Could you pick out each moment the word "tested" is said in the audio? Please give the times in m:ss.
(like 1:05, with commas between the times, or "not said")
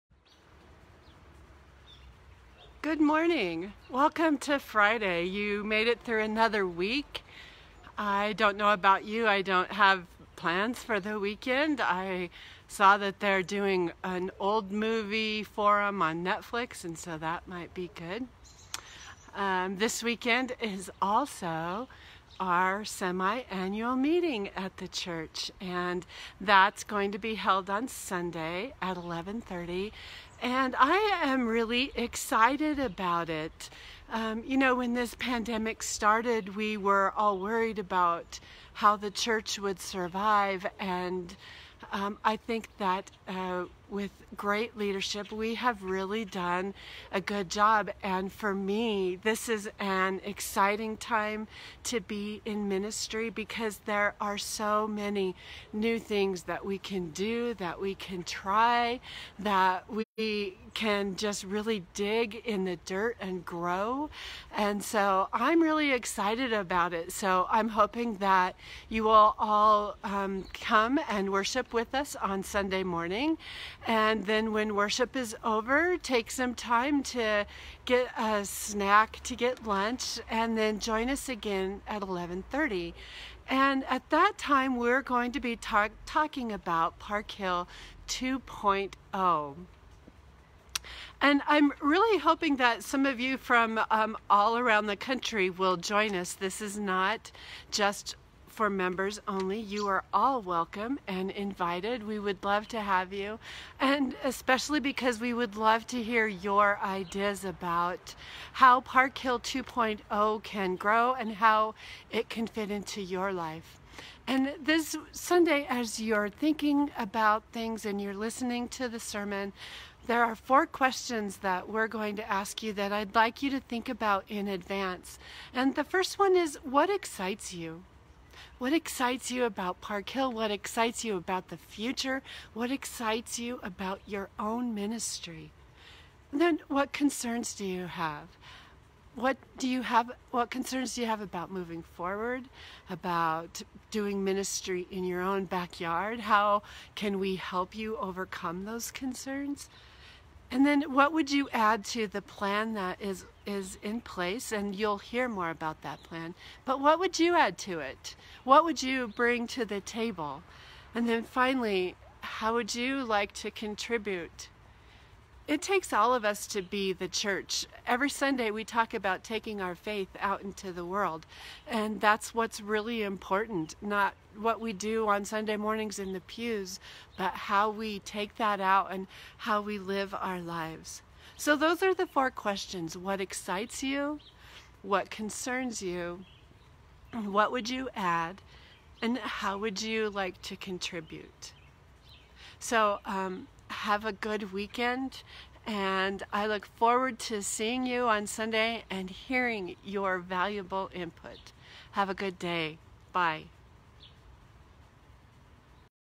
not said.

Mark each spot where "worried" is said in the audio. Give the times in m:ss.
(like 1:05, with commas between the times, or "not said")
0:37.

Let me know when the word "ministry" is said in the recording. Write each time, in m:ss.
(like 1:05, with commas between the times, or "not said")
0:52, 2:14, 2:24.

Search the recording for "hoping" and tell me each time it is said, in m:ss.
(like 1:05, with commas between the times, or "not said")
1:07, 1:32.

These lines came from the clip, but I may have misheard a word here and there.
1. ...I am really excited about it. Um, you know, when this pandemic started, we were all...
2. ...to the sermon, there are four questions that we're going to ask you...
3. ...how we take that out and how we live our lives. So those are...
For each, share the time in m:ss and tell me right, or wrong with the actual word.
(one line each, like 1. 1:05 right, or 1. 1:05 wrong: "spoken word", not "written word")
1. 0:30 right
2. 1:58 right
3. 2:57 right.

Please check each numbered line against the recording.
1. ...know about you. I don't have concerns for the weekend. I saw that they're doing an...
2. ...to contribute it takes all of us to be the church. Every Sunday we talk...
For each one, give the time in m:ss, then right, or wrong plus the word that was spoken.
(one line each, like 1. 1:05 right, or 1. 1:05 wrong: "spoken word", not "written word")
1. 0:08 wrong: "plans", not "concerns"
2. 2:43 right.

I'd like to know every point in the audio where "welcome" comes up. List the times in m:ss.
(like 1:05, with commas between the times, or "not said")
0:03, 1:40.